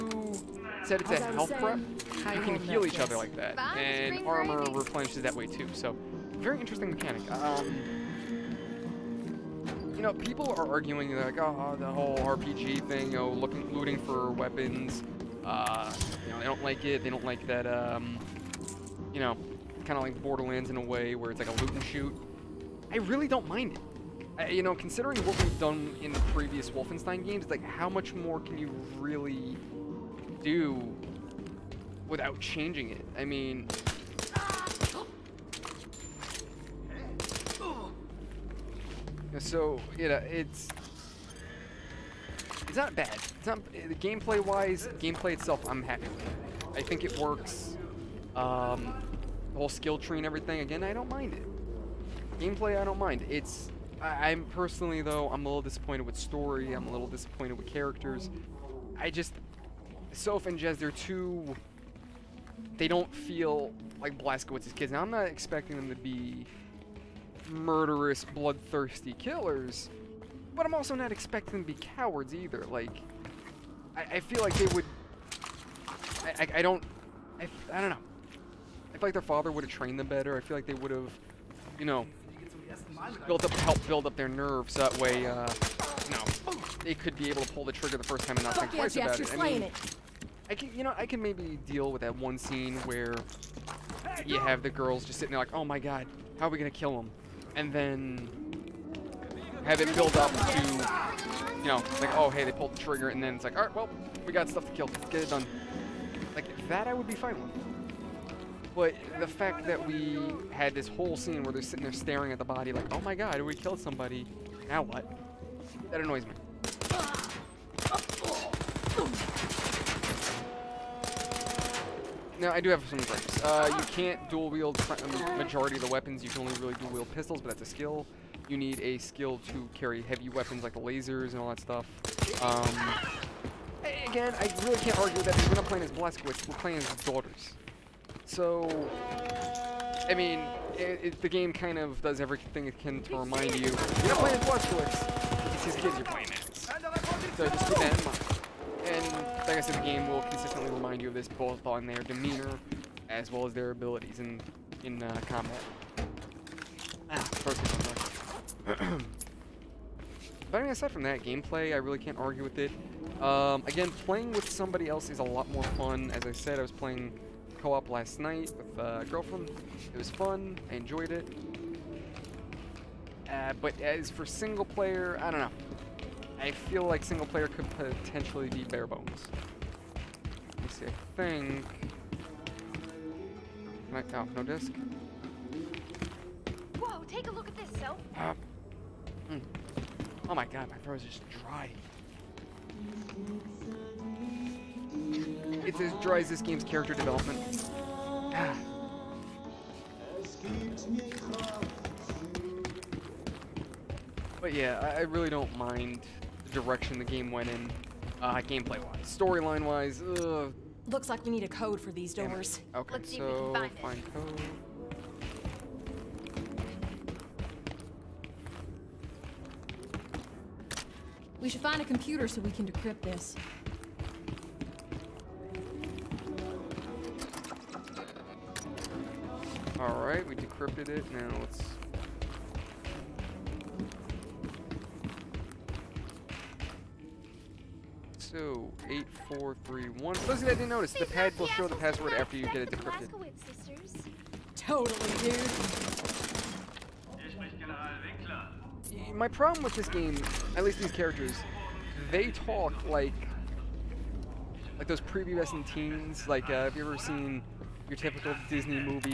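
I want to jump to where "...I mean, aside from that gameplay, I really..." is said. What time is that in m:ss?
2:40.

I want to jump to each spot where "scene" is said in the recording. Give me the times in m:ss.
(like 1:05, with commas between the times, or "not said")
1:32, 1:51.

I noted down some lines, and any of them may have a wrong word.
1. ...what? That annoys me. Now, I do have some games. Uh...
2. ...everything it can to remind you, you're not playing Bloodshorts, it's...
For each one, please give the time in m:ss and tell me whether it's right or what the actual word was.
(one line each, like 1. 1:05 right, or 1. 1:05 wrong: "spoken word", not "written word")
1. 1:54 wrong: "gripes", not "games"
2. 2:22 right.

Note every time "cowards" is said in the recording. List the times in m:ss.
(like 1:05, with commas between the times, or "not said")
1:11.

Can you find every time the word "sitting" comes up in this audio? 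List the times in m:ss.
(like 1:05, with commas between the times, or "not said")
1:35, 1:51.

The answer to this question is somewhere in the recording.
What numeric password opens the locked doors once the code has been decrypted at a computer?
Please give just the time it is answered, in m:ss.
3:58.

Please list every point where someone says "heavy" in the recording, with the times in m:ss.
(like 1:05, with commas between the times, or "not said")
2:10.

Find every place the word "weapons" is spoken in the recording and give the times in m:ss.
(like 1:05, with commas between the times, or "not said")
0:14, 2:05, 2:10.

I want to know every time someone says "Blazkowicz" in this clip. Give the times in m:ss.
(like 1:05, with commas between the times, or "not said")
1:04, 2:15.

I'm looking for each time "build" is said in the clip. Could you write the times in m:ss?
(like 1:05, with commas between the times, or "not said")
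1:23, 1:39.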